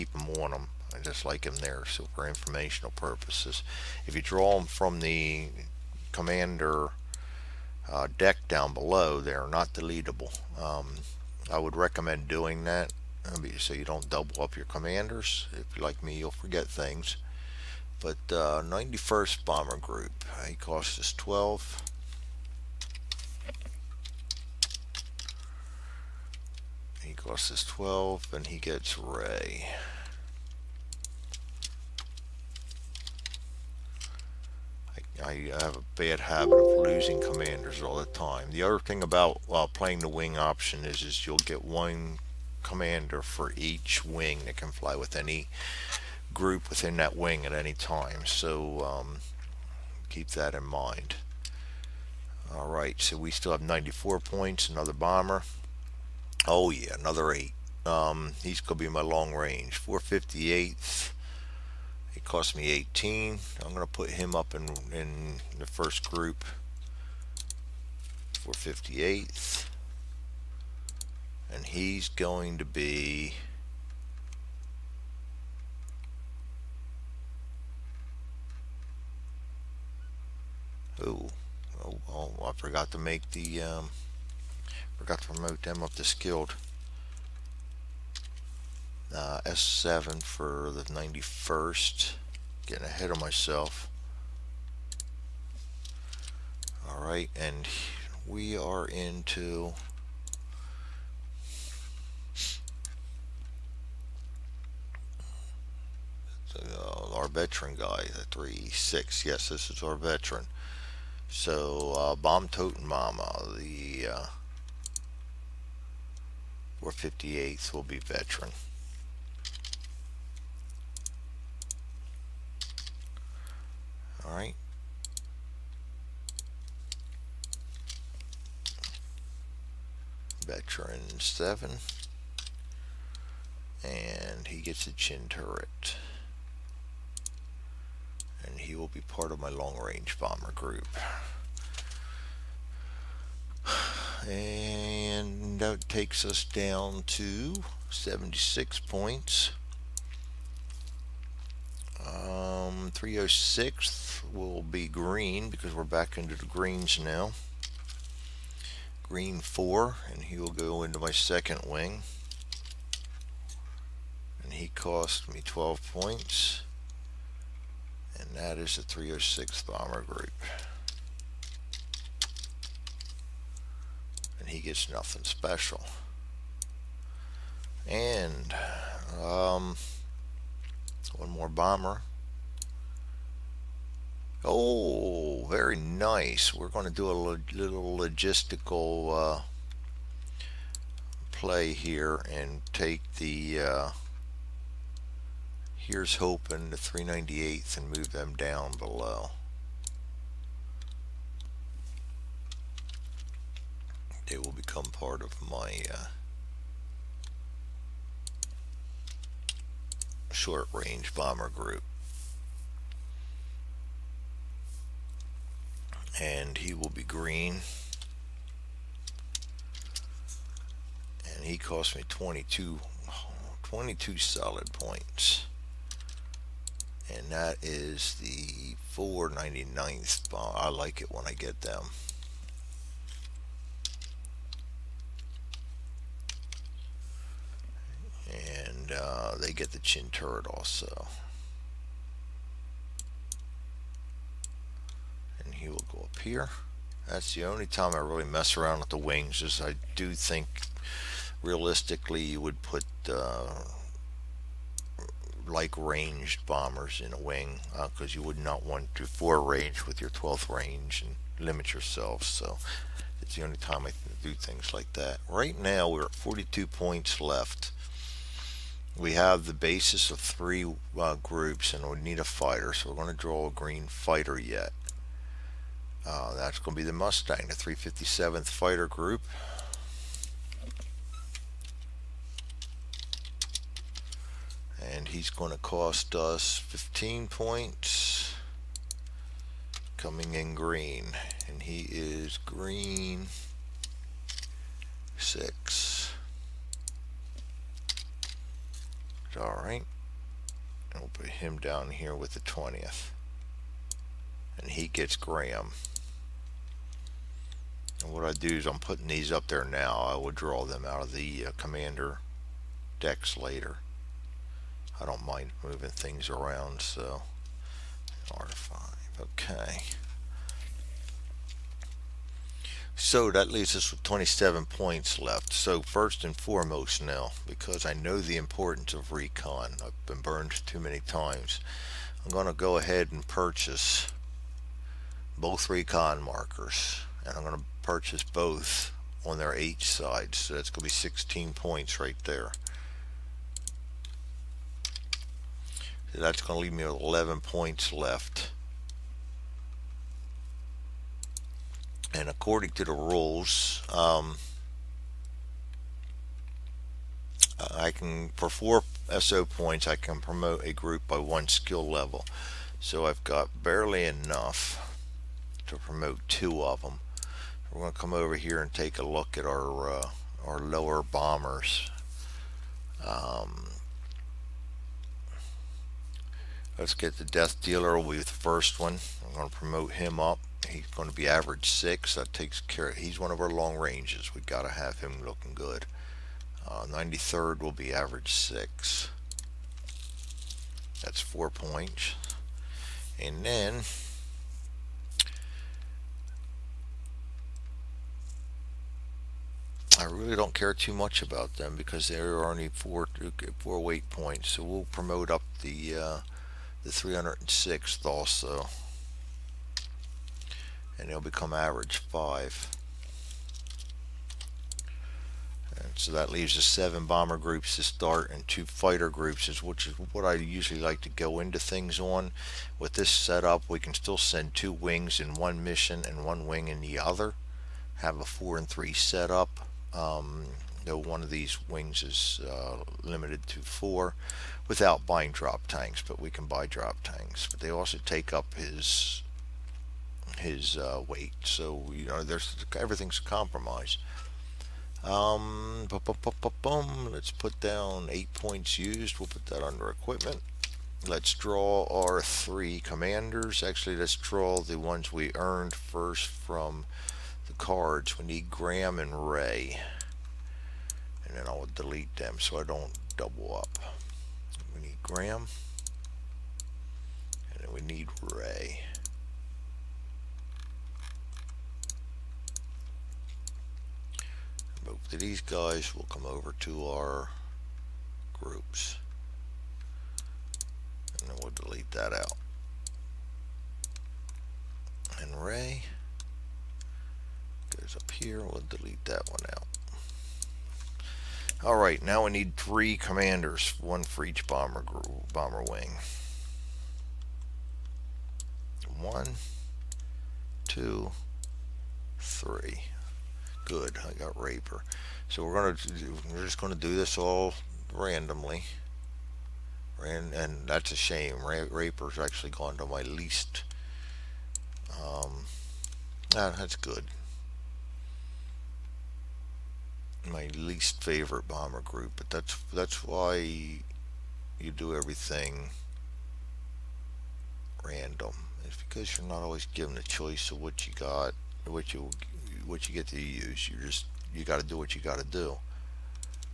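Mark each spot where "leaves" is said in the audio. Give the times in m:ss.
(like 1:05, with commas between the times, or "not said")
5:23, 5:46, 6:56.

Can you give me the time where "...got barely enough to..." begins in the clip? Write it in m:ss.
6:03.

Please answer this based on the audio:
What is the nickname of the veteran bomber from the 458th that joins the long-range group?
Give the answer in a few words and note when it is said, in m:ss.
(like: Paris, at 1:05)
Bomb Totem Mama, at 1:52.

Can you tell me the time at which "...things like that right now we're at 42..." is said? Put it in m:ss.
4:24.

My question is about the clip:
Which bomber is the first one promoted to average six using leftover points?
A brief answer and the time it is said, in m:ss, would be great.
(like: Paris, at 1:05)
Death Dealer, at 6:17.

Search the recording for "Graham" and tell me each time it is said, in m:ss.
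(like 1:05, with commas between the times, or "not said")
5:05, 7:38, 7:45.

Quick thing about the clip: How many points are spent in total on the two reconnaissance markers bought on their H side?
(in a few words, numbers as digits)
16.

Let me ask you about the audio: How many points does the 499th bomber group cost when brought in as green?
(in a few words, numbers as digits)
22.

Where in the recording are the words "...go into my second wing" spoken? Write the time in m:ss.
2:40.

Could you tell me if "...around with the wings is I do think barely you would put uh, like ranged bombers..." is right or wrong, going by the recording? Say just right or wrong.
wrong.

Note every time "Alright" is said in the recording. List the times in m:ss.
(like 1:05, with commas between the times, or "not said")
1:36, 4:59.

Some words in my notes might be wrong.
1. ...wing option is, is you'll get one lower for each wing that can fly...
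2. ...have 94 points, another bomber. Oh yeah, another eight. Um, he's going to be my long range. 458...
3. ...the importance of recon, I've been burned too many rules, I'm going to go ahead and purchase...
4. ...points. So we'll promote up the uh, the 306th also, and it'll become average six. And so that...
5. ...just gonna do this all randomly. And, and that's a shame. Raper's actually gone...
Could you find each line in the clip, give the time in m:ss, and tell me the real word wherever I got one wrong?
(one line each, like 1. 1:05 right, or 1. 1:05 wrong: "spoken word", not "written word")
1. 0:40 wrong: "commander", not "lower"
2. 0:53 right
3. 5:28 wrong: "times", not "rules"
4. 6:44 wrong: "five", not "six"
5. 8:26 right.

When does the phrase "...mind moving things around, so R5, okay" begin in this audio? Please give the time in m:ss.
5:15.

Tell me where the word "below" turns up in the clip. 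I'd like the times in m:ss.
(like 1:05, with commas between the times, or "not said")
0:08, 3:18.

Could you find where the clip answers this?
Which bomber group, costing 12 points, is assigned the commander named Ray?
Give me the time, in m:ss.
0:18.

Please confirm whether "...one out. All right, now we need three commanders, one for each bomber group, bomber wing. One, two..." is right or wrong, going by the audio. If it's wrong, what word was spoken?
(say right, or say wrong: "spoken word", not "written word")
right.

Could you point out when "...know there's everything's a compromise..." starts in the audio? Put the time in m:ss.
7:22.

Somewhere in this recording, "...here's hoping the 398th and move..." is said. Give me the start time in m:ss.
3:15.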